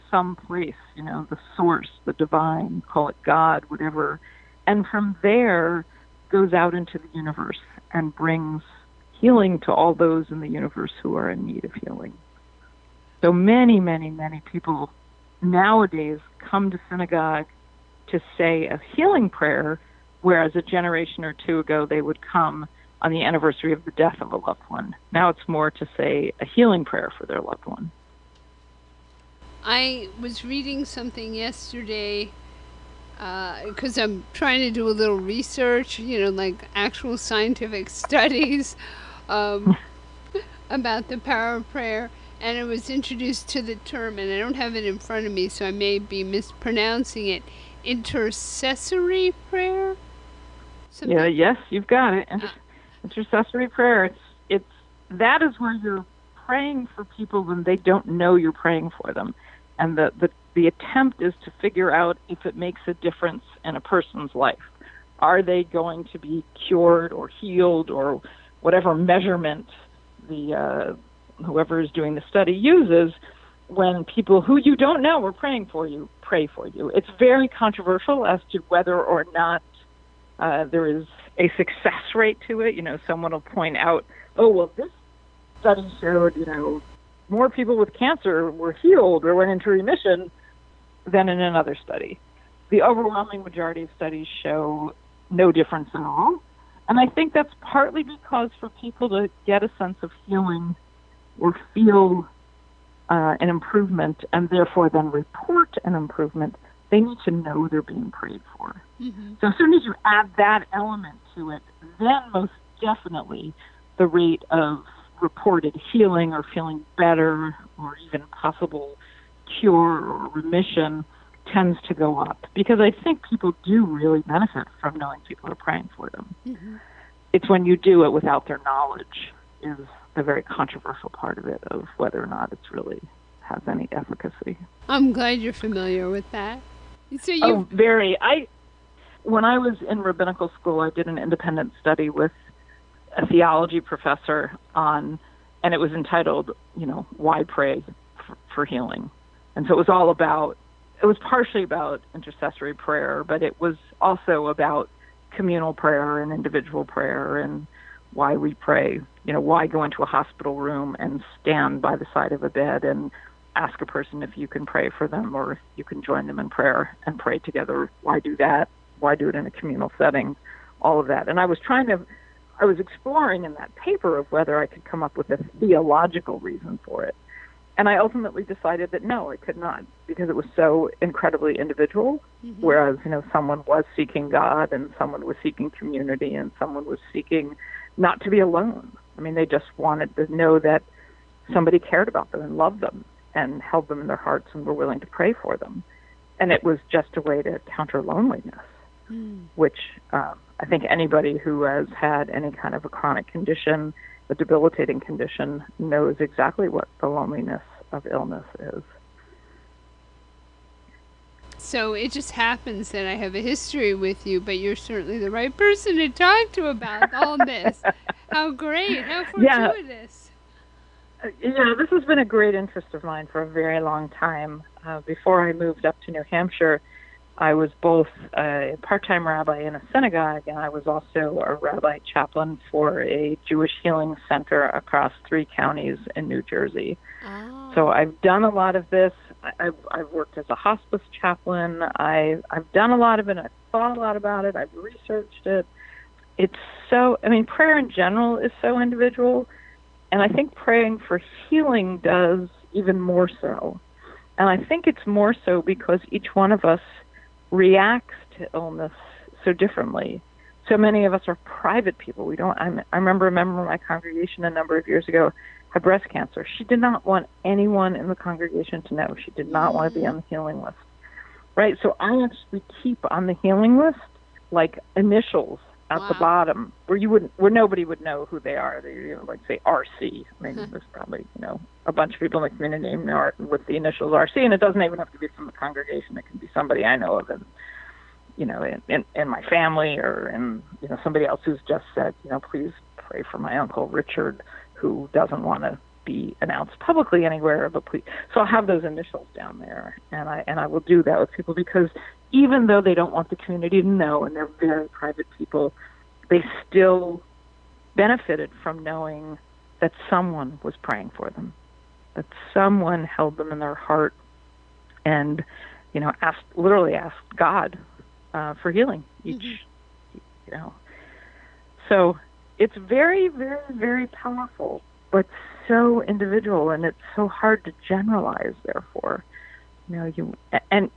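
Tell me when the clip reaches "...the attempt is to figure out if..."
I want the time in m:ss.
1:00.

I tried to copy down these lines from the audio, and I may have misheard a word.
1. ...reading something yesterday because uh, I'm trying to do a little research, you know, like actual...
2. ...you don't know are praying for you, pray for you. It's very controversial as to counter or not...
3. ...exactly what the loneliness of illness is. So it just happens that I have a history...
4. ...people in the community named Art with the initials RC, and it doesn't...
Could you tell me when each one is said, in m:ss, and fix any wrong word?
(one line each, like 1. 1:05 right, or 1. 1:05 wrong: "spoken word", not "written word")
1. 0:30 right
2. 1:14 wrong: "whether", not "counter"
3. 3:26 right
4. 4:42 right.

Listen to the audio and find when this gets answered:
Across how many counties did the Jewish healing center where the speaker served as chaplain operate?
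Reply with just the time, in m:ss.
3:55.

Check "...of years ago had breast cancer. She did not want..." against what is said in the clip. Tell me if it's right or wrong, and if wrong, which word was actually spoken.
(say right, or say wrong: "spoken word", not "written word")
right.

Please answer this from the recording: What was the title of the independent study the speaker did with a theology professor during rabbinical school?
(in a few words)
Why Pray for Healing?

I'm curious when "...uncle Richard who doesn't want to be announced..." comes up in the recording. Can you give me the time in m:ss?
4:53.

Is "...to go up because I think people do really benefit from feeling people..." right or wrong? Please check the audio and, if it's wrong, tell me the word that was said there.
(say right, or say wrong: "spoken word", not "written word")
wrong: "knowing", not "feeling".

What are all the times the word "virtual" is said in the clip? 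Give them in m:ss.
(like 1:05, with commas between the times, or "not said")
not said.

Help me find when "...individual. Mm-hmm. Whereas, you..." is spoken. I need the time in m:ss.
3:01.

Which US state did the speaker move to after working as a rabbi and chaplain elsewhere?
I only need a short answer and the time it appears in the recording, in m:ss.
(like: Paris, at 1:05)
New Hampshire, at 3:46.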